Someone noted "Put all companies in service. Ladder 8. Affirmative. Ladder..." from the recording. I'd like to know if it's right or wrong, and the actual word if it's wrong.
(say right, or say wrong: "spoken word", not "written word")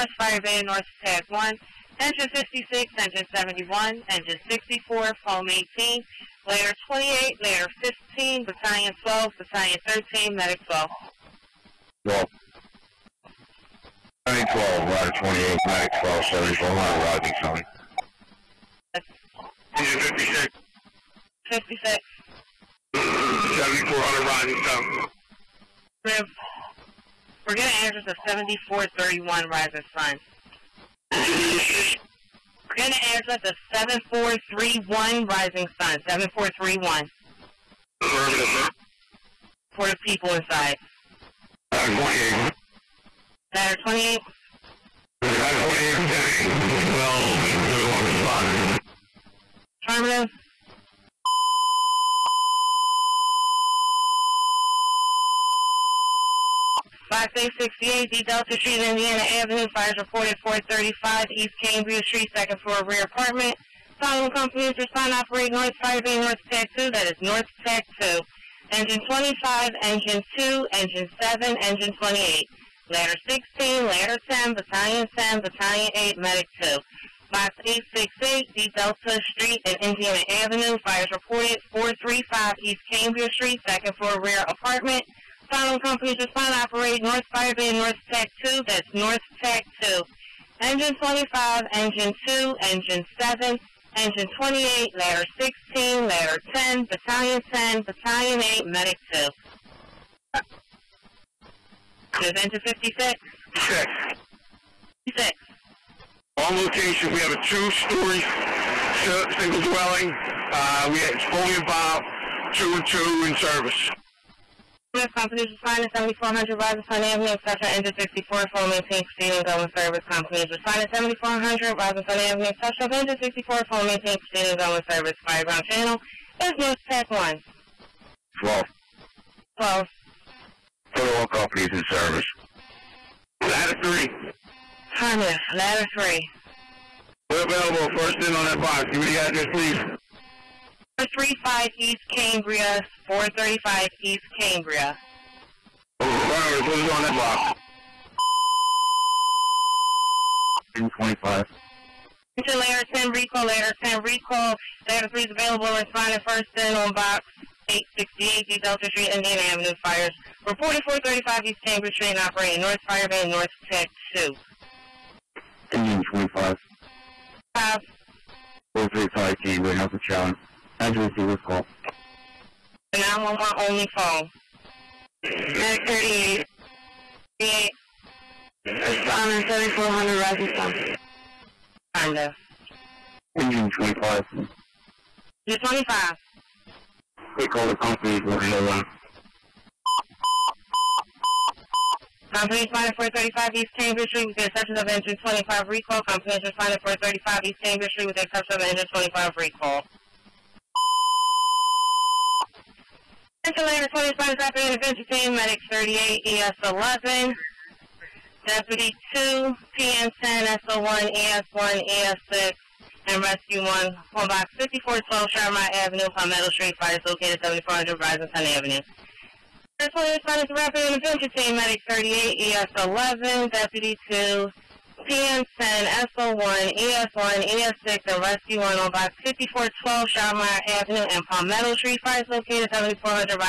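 wrong: "3", not "8".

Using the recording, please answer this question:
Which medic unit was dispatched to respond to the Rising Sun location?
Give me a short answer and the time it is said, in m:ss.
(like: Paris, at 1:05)
Medic 38, at 2:55.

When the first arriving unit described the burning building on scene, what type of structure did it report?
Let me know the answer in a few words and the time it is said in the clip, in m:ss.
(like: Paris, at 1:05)
Two-story single dwelling, at 1:47.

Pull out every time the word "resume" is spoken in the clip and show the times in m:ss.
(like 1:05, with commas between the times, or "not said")
not said.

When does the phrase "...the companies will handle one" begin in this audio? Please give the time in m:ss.
3:07.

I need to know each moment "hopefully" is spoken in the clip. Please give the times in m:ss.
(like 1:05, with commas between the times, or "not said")
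not said.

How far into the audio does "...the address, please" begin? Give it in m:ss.
2:19.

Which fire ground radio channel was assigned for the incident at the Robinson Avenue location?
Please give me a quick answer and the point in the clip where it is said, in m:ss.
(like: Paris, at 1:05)
North Tech 1, at 2:05.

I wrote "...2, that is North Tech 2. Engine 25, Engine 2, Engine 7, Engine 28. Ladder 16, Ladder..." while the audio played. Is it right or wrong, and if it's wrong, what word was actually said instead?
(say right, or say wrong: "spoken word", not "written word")
right.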